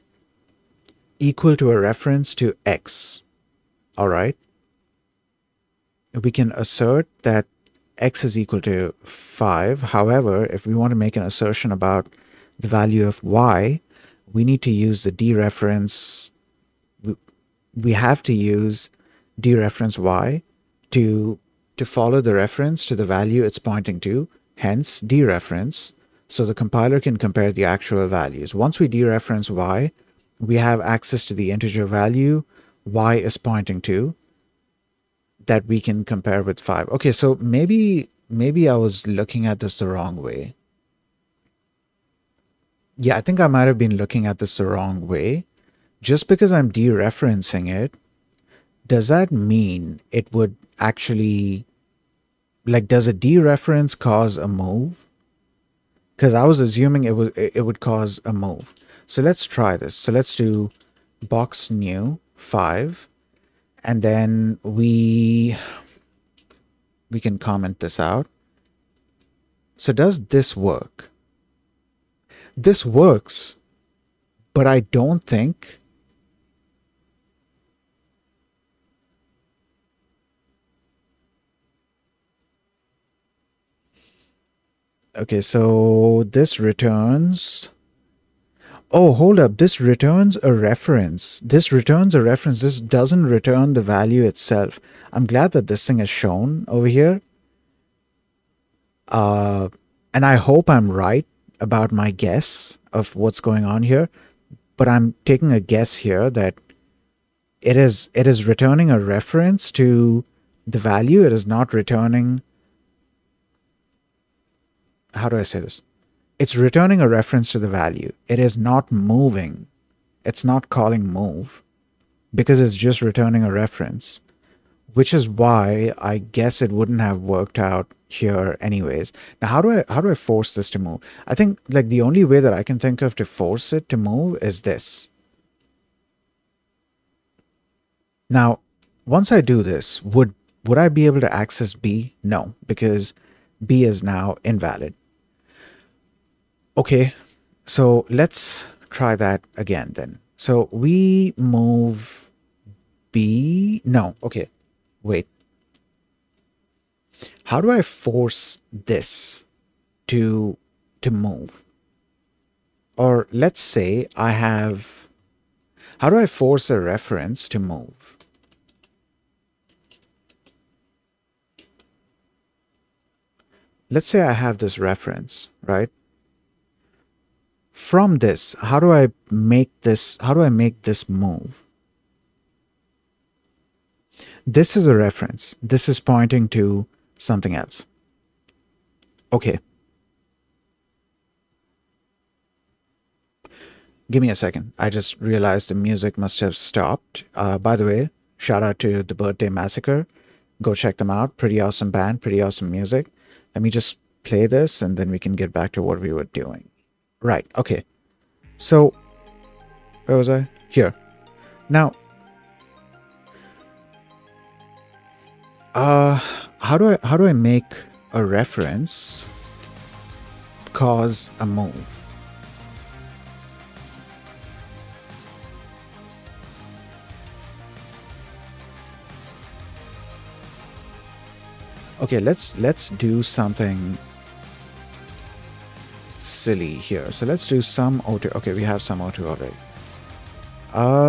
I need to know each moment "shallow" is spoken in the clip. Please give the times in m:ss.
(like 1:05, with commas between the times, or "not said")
not said.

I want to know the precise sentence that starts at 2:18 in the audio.
Now, once I do this, would would I be able to access B?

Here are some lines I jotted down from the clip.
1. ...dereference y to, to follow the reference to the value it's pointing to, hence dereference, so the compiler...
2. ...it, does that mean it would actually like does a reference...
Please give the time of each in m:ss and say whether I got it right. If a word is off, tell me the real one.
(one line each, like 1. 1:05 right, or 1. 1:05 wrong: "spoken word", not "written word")
1. 0:19 right
2. 0:47 wrong: "dereference", not "reference".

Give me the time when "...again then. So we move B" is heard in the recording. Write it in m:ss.
2:29.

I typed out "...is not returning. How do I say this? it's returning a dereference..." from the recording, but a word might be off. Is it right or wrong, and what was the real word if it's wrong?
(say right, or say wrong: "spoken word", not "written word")
wrong: "reference", not "dereference".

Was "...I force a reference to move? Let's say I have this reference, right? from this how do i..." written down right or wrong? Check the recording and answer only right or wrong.
right.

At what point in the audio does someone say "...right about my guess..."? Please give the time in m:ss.
1:40.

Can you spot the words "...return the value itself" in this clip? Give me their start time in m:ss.
1:33.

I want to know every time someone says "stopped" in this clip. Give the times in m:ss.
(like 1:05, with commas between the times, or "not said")
3:16.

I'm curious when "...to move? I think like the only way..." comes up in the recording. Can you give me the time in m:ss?
2:10.